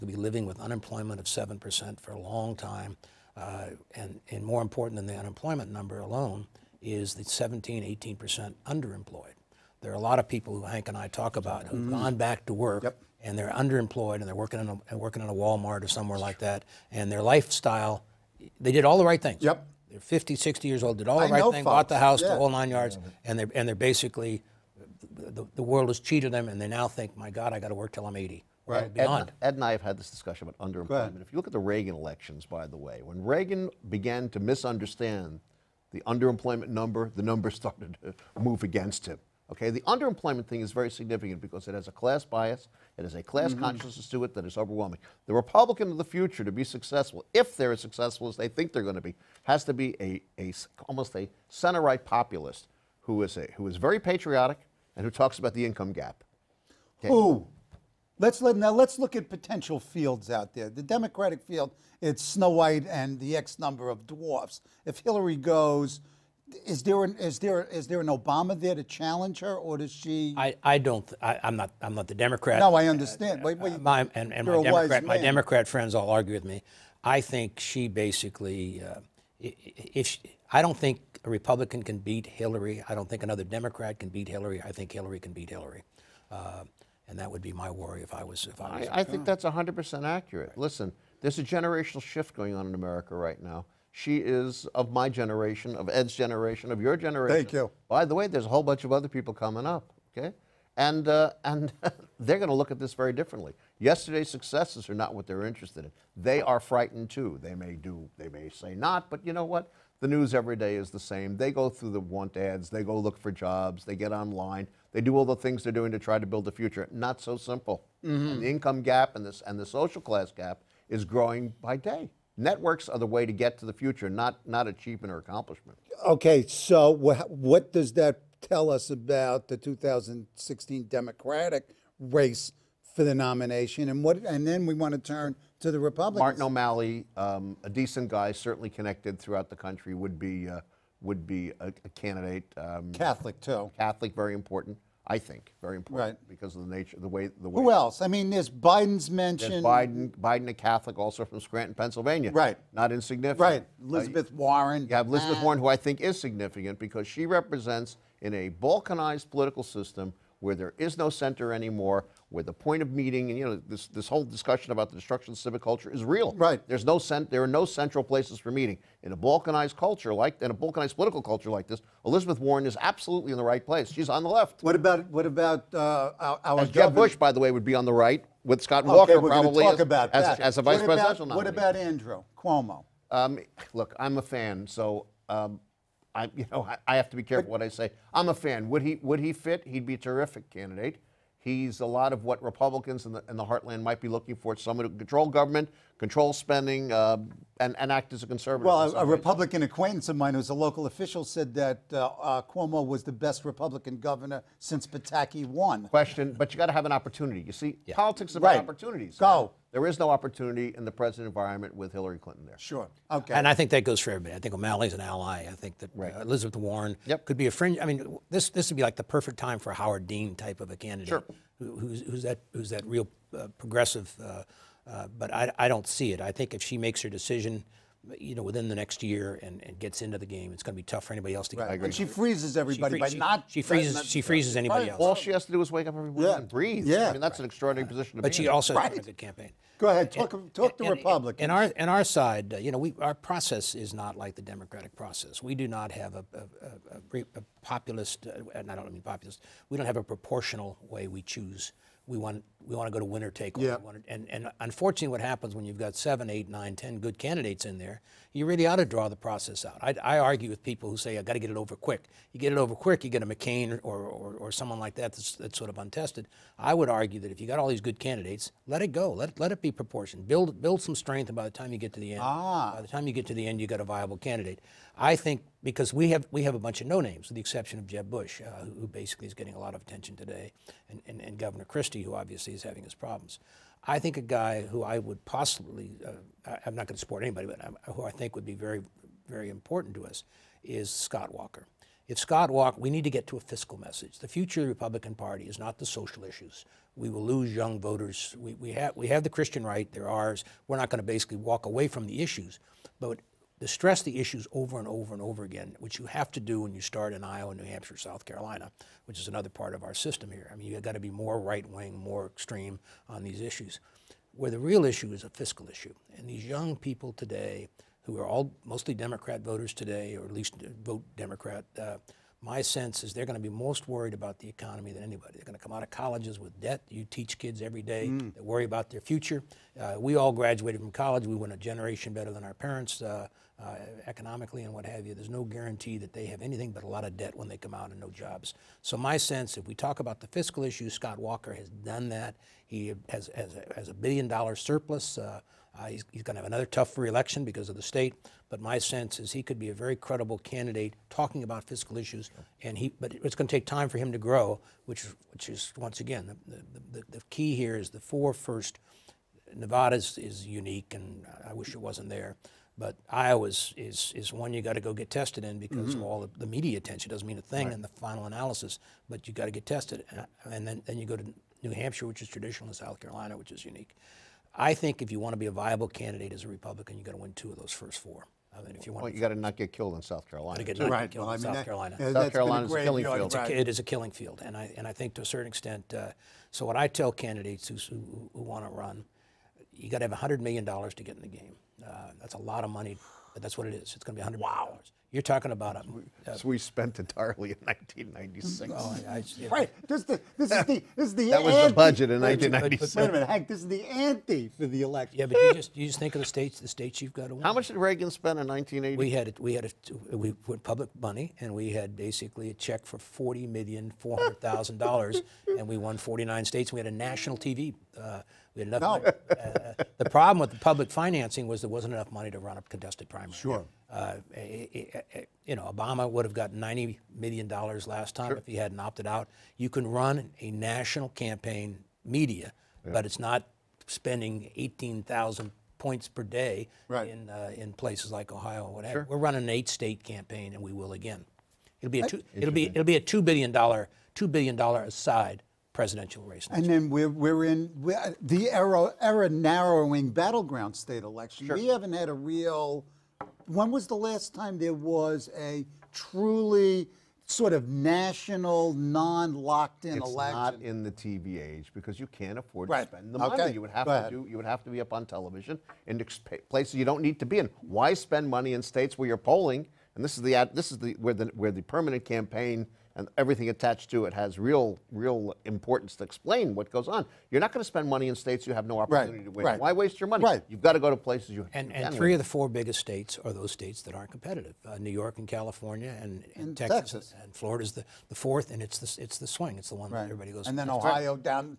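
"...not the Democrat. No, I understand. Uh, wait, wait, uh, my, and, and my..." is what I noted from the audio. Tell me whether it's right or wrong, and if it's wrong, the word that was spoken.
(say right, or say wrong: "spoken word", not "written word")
right.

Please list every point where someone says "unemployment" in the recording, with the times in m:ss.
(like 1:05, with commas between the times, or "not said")
0:00, 0:05.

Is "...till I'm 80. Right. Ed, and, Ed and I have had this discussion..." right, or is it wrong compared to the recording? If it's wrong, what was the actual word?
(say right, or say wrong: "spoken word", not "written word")
right.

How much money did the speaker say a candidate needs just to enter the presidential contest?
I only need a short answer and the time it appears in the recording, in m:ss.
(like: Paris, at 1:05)
$100 million, at 6:30.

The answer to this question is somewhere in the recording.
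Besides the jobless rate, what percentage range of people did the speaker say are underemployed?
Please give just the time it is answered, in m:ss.
0:07.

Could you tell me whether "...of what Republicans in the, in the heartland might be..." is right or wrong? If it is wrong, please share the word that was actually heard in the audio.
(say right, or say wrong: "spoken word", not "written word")
right.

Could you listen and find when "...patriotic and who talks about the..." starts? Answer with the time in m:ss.
0:53.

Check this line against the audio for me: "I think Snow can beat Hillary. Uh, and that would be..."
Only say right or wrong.
wrong.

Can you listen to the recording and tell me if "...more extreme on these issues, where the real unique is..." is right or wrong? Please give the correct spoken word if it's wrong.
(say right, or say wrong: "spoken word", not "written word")
wrong: "issue", not "unique".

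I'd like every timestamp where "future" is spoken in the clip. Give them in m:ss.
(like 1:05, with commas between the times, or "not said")
0:46, 1:56, 2:03, 4:54, 5:29.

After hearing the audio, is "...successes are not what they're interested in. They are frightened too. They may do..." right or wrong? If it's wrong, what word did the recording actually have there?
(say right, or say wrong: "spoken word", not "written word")
right.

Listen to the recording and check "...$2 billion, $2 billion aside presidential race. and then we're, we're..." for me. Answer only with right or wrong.
right.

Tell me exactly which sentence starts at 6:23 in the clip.
It's a, it is a killing field, and I and I think to a certain extent.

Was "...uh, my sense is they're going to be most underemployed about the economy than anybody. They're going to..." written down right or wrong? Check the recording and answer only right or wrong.
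wrong.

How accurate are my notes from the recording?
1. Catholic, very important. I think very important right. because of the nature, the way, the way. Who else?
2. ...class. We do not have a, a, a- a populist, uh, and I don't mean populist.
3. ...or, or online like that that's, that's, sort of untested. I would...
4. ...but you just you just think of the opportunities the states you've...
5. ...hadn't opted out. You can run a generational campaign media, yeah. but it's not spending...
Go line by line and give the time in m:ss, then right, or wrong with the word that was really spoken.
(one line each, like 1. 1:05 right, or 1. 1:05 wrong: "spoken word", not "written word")
1. 2:23 right
2. 4:04 wrong: "process", not "class"
3. 4:23 wrong: "someone", not "online"
4. 6:45 wrong: "states", not "opportunities"
5. 7:08 wrong: "national", not "generational".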